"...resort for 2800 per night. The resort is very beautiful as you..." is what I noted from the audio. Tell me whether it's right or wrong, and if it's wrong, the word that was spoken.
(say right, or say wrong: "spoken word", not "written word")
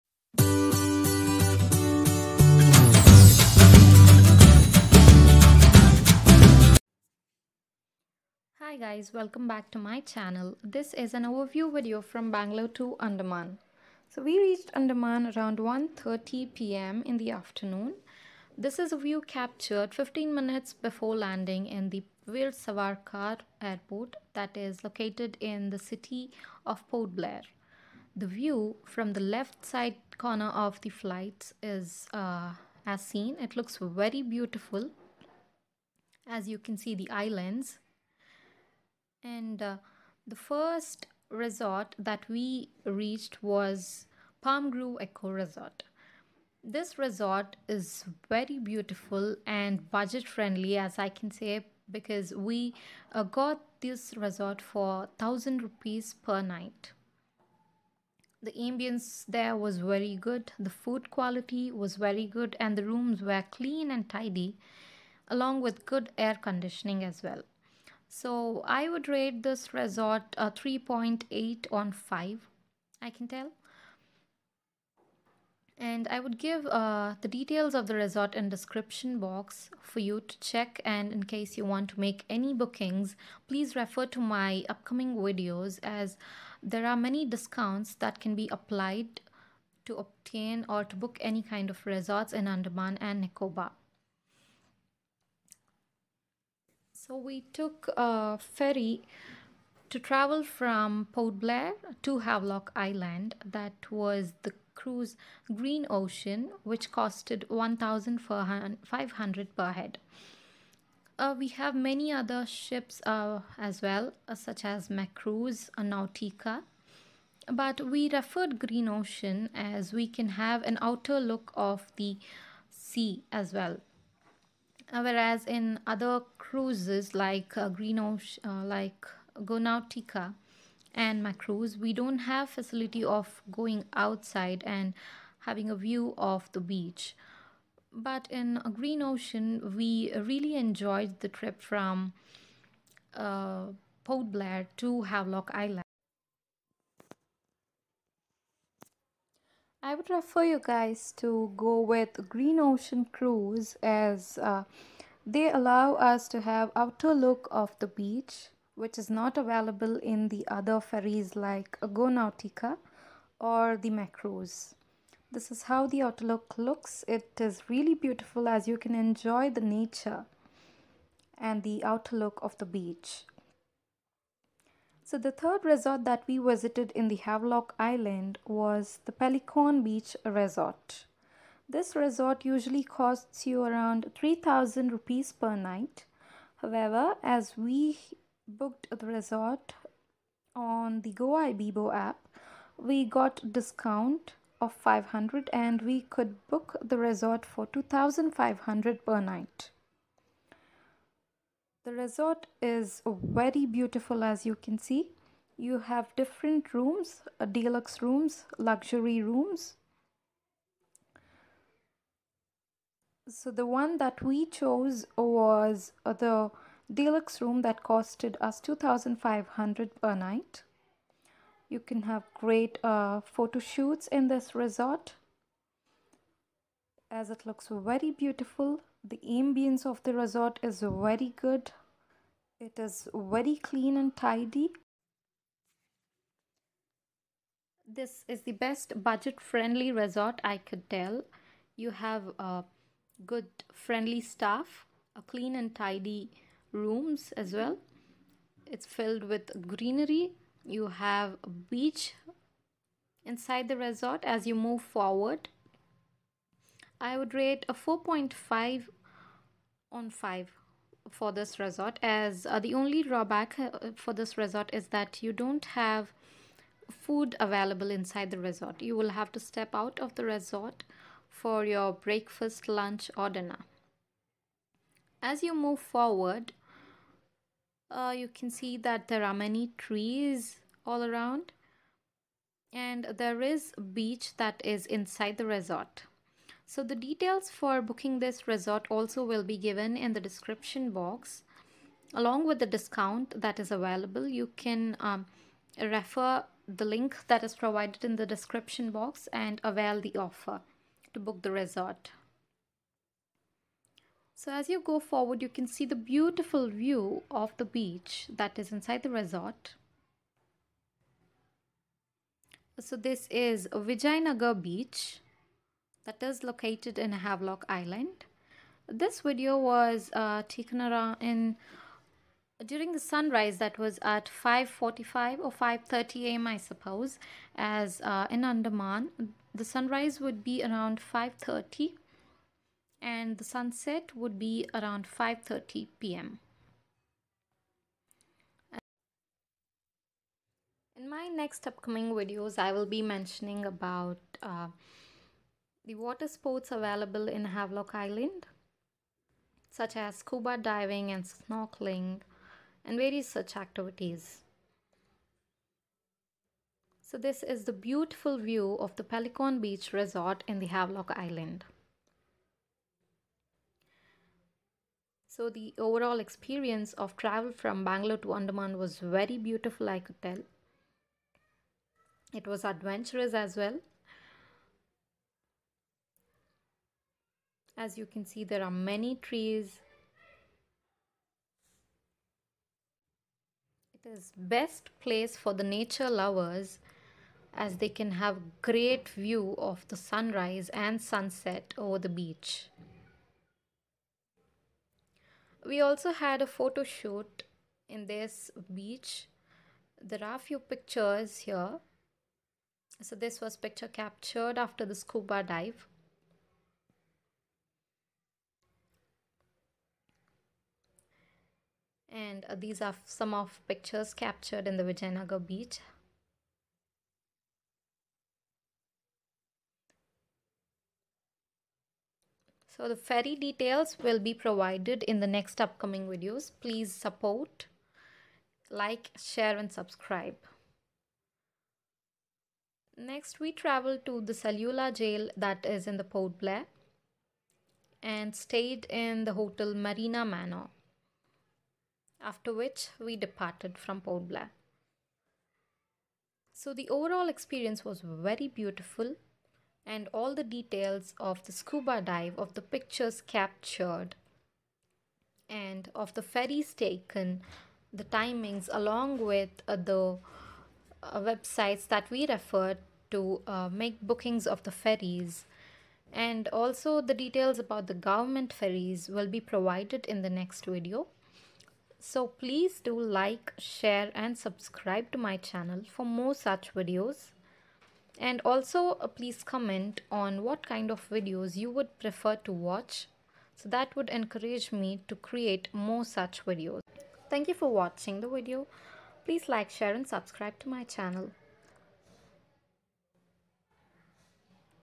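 wrong: "2500", not "2800".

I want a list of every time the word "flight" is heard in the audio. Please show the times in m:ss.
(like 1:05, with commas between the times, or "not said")
0:30.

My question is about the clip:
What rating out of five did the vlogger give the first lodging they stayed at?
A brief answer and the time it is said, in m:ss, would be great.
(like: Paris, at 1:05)
3.8, at 1:10.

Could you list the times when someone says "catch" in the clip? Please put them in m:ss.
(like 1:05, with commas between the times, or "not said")
not said.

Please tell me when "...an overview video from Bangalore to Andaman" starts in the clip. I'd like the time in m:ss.
0:11.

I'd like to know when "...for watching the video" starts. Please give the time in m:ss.
8:07.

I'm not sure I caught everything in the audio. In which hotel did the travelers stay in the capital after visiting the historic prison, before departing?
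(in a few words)
Marina Manor.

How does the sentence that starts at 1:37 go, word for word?
So we took a ferry to travel from Port Blair to Havelock Island.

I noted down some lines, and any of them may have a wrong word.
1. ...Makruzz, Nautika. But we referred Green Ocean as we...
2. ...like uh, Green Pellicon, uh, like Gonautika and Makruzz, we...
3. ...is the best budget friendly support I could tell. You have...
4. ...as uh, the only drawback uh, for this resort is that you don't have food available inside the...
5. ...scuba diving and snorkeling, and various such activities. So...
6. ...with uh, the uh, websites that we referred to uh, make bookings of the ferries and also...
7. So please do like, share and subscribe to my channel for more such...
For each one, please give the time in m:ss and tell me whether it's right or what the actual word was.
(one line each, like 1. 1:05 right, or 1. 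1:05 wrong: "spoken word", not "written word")
1. 1:54 right
2. 2:07 wrong: "Ocean", not "Pellicon"
3. 3:58 wrong: "resort", not "support"
4. 4:22 right
5. 5:50 right
6. 7:39 right
7. 7:52 right.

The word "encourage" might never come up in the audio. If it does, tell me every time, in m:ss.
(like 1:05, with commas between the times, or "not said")
8:04.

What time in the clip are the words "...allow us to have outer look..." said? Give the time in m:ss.
2:35.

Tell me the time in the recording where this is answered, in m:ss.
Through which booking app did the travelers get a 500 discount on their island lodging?
3:11.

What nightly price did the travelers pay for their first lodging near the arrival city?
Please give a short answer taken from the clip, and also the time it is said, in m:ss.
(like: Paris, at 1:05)
1000 rupees, at 0:55.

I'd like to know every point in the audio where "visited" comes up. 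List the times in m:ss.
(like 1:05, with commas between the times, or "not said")
2:56.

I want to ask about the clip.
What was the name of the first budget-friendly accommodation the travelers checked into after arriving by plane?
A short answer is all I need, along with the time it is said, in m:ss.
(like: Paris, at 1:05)
Palm Grove Eco Resort, at 0:44.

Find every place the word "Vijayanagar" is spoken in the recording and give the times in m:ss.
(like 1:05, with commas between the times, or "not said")
5:13, 6:54.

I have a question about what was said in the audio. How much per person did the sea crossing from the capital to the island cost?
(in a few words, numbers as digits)
1,500.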